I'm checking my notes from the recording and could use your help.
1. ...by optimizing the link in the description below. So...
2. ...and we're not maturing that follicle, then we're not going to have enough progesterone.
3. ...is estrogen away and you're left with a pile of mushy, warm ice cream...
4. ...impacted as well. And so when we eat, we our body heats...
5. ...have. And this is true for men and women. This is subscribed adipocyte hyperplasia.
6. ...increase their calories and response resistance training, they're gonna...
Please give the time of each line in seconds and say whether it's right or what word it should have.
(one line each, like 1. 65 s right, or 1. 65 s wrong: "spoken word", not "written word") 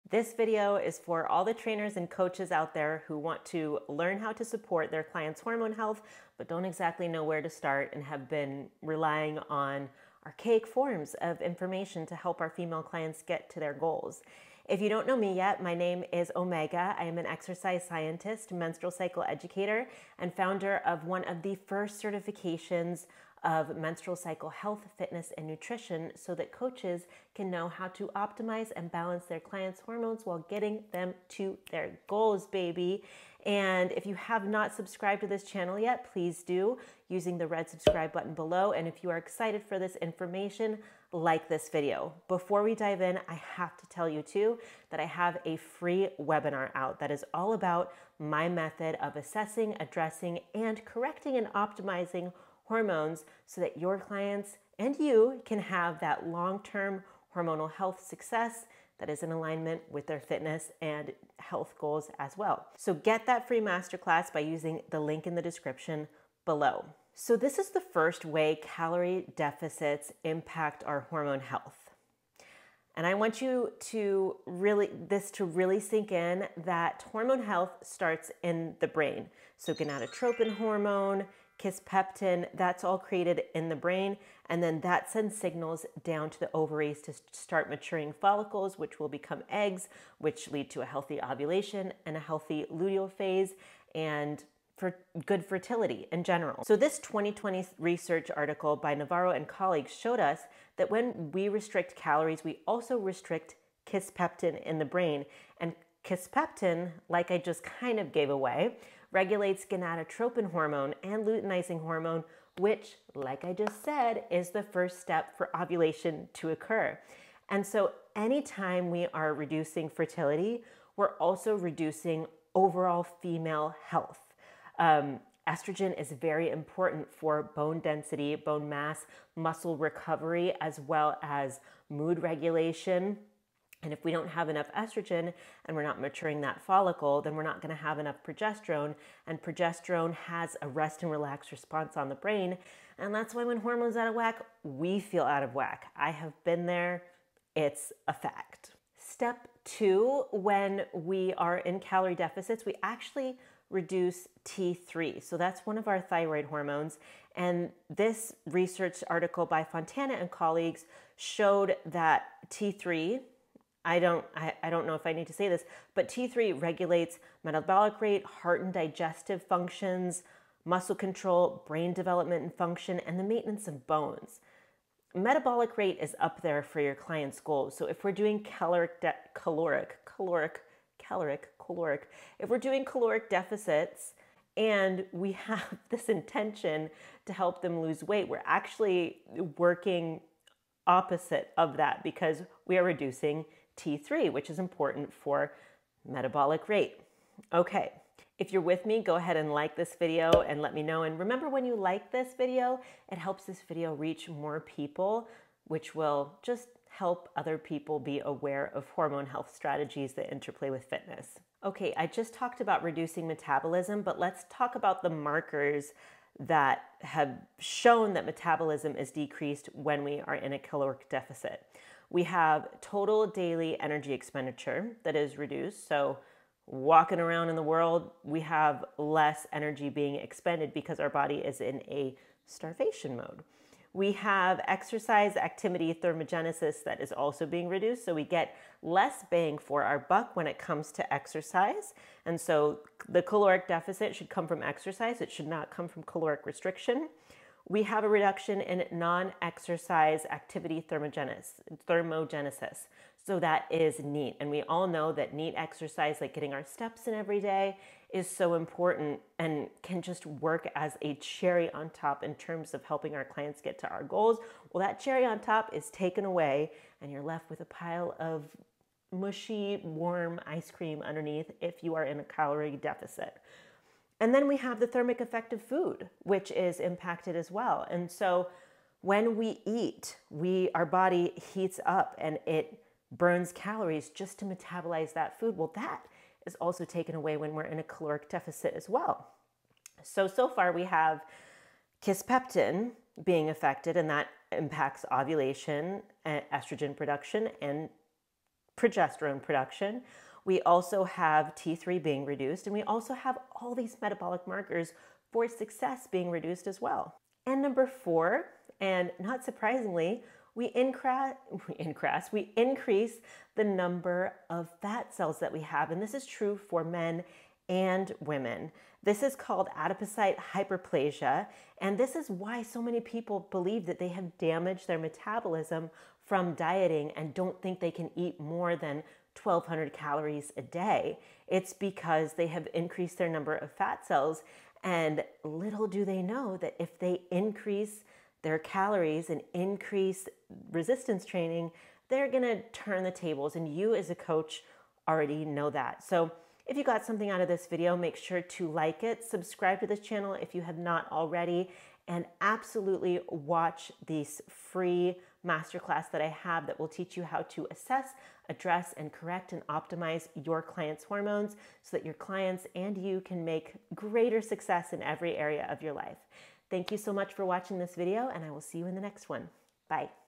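1. 64 s wrong: "using", not "optimizing"
2. 135 s right
3. 265 s wrong: "taken", not "estrogen"
4. 276 s right
5. 315 s wrong: "called", not "subscribed"
6. 337 s wrong: "increase", not "response".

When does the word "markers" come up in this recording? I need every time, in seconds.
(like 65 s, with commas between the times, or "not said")
215 s, 304 s.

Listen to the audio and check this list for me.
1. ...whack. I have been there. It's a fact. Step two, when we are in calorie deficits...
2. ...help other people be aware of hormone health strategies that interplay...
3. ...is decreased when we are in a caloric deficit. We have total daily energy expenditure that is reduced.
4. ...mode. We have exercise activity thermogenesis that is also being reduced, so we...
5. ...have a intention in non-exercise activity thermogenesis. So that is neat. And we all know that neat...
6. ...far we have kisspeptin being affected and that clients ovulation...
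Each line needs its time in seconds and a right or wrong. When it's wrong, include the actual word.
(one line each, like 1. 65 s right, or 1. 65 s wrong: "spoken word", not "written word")
1. 145 s right
2. 206 s right
3. 218 s right
4. 233 s right
5. 247 s wrong: "reduction", not "intention"
6. 290 s wrong: "impacts", not "clients".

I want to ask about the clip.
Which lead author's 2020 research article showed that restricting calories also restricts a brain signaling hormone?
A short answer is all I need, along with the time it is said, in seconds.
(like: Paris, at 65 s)
Navarro, at 98 s.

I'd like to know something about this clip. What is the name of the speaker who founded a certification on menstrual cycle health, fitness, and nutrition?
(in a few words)
Omega.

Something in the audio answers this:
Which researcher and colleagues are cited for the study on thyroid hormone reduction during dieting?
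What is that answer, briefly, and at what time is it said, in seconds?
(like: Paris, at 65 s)
Fontana, at 159 s.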